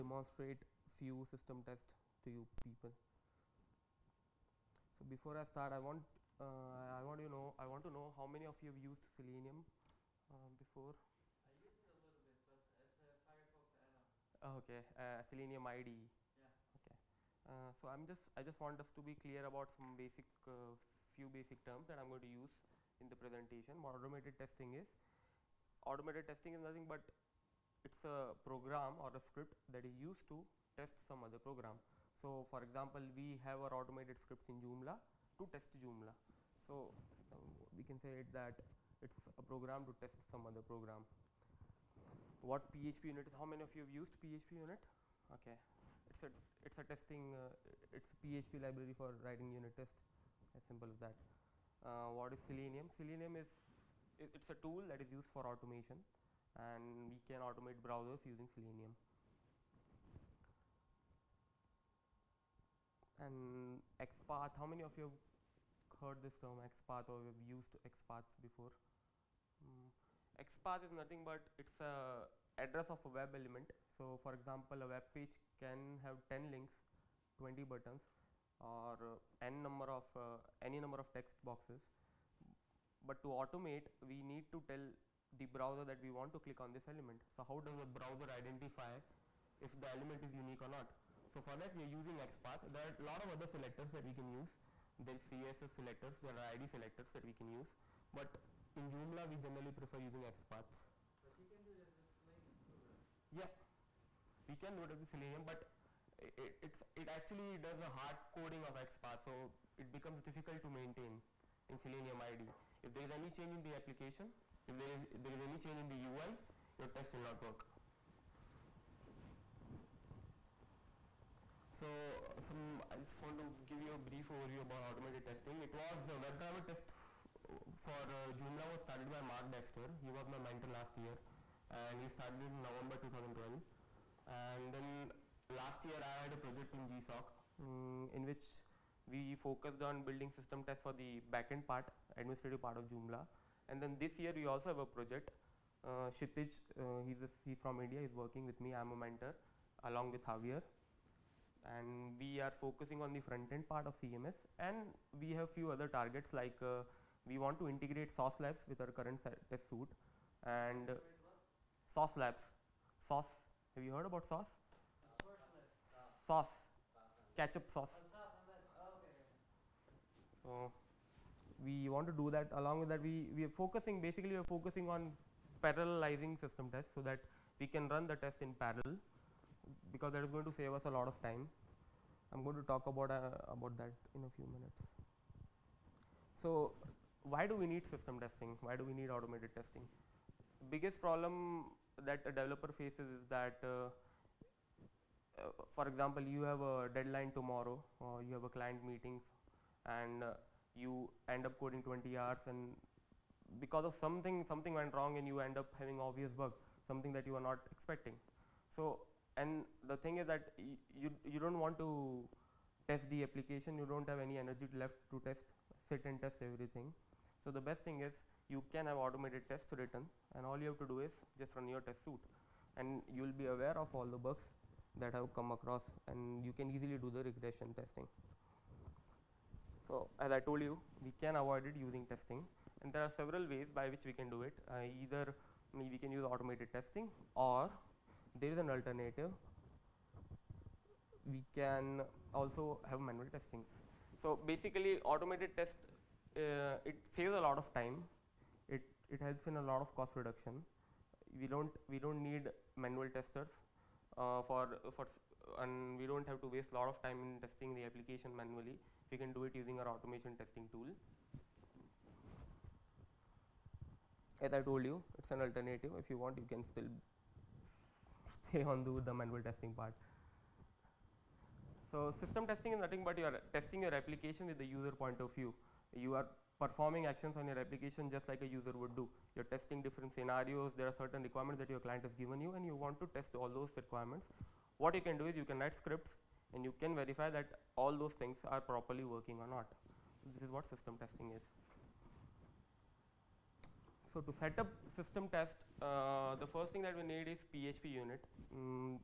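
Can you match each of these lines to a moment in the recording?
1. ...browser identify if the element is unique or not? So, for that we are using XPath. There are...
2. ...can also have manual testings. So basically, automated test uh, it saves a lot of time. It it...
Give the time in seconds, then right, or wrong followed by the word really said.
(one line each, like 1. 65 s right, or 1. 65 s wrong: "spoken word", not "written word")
1. 87 s right
2. 241 s right.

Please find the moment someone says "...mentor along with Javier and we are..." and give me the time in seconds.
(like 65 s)
148 s.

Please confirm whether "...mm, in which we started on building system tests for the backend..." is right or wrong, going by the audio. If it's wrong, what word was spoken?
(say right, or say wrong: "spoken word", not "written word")
wrong: "focused", not "started".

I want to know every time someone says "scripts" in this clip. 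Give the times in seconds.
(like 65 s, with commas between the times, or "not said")
29 s, 34 s, 285 s.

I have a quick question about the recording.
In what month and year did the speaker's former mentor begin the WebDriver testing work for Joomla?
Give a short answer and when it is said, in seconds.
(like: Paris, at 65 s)
November 2012, at 132 s.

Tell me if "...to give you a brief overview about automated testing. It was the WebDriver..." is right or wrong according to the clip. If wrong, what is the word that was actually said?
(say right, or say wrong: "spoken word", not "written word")
right.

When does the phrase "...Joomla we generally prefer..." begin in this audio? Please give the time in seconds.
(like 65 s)
98 s.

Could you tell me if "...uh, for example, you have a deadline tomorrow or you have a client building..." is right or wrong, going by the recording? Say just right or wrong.
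wrong.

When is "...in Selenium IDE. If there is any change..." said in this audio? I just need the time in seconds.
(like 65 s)
111 s.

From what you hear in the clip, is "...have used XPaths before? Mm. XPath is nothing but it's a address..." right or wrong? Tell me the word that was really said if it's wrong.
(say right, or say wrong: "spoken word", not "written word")
right.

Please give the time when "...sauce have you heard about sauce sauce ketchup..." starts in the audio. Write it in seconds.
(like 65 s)
163 s.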